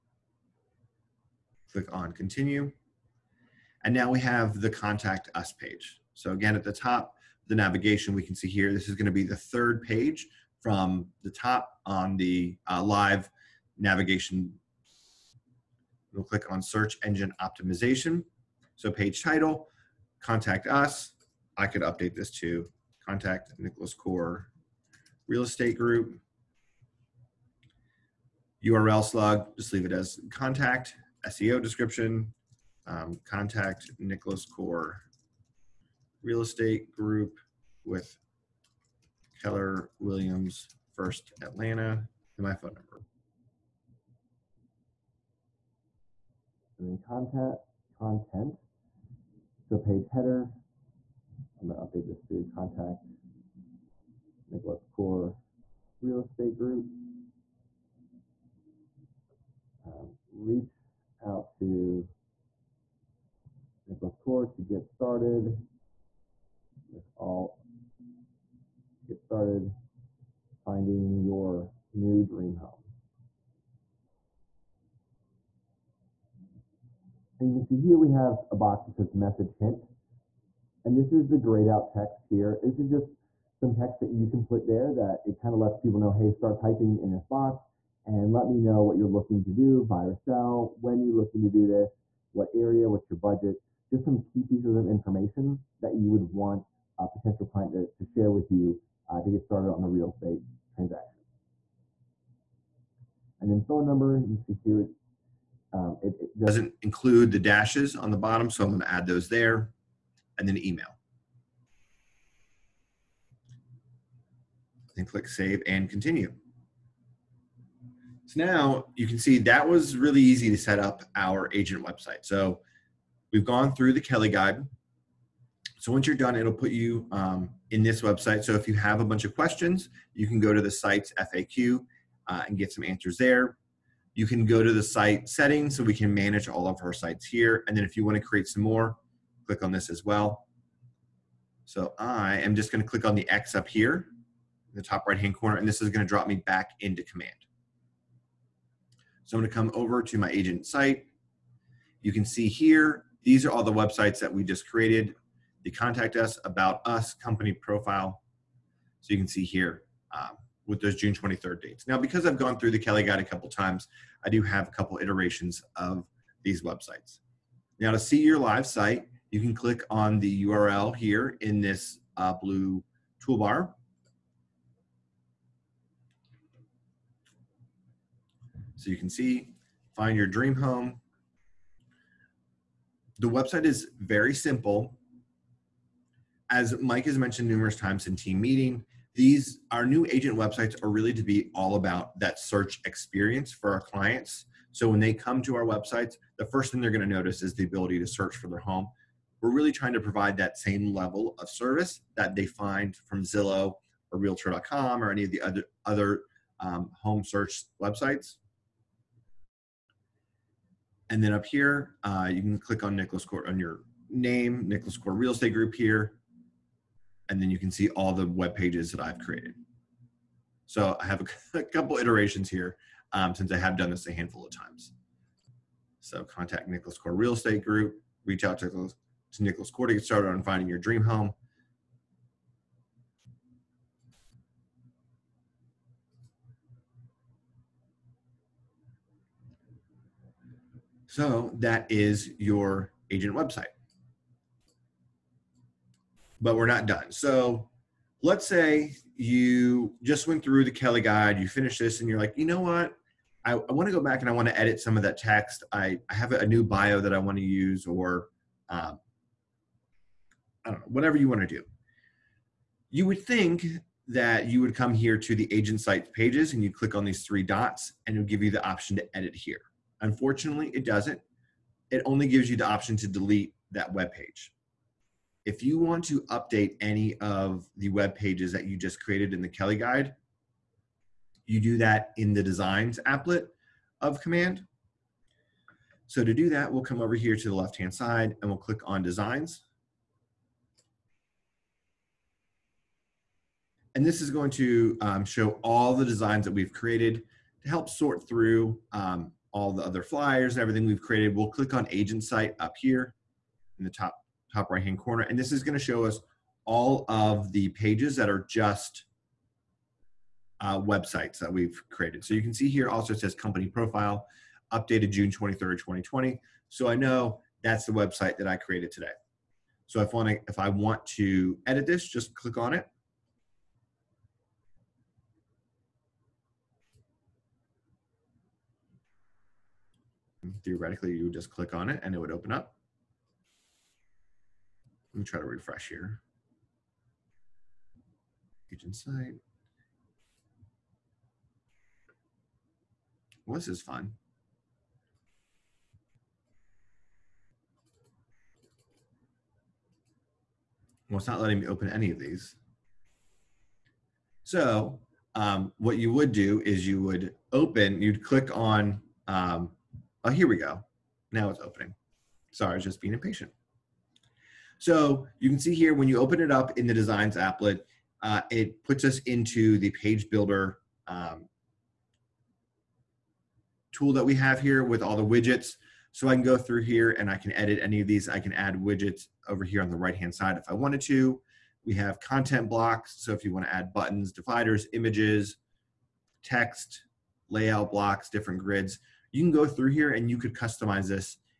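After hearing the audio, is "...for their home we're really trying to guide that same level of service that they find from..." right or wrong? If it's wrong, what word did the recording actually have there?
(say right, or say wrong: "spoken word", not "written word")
wrong: "provide", not "guide".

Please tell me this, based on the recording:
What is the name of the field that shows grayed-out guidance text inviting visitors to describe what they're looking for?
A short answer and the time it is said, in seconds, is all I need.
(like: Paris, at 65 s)
message hint, at 79 s.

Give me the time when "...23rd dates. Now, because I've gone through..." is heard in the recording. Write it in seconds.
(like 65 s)
161 s.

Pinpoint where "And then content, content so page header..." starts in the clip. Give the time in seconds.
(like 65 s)
46 s.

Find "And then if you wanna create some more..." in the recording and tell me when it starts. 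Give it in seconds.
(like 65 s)
137 s.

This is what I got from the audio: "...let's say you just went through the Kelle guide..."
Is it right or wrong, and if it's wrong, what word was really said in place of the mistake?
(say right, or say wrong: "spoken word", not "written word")
right.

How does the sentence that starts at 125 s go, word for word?
So once you're done, it'll put you um, in this website.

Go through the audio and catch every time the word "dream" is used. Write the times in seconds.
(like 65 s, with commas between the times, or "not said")
72 s, 180 s, 230 s.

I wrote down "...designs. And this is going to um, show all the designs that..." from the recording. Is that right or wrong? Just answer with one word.
right.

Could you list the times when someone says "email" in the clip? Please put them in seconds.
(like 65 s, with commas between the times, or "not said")
110 s.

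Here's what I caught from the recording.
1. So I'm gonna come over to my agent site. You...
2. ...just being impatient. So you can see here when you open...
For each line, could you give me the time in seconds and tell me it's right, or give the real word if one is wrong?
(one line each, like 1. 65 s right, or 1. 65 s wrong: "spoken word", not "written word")
1. 149 s right
2. 362 s right.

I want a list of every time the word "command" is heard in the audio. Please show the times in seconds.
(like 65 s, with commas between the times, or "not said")
147 s, 284 s.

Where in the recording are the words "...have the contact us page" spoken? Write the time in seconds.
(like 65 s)
4 s.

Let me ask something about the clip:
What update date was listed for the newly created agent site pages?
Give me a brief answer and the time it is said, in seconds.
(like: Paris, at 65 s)
June 23rd, 2020, at 315 s.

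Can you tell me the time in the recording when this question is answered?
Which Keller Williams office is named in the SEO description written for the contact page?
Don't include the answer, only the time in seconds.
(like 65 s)
40 s.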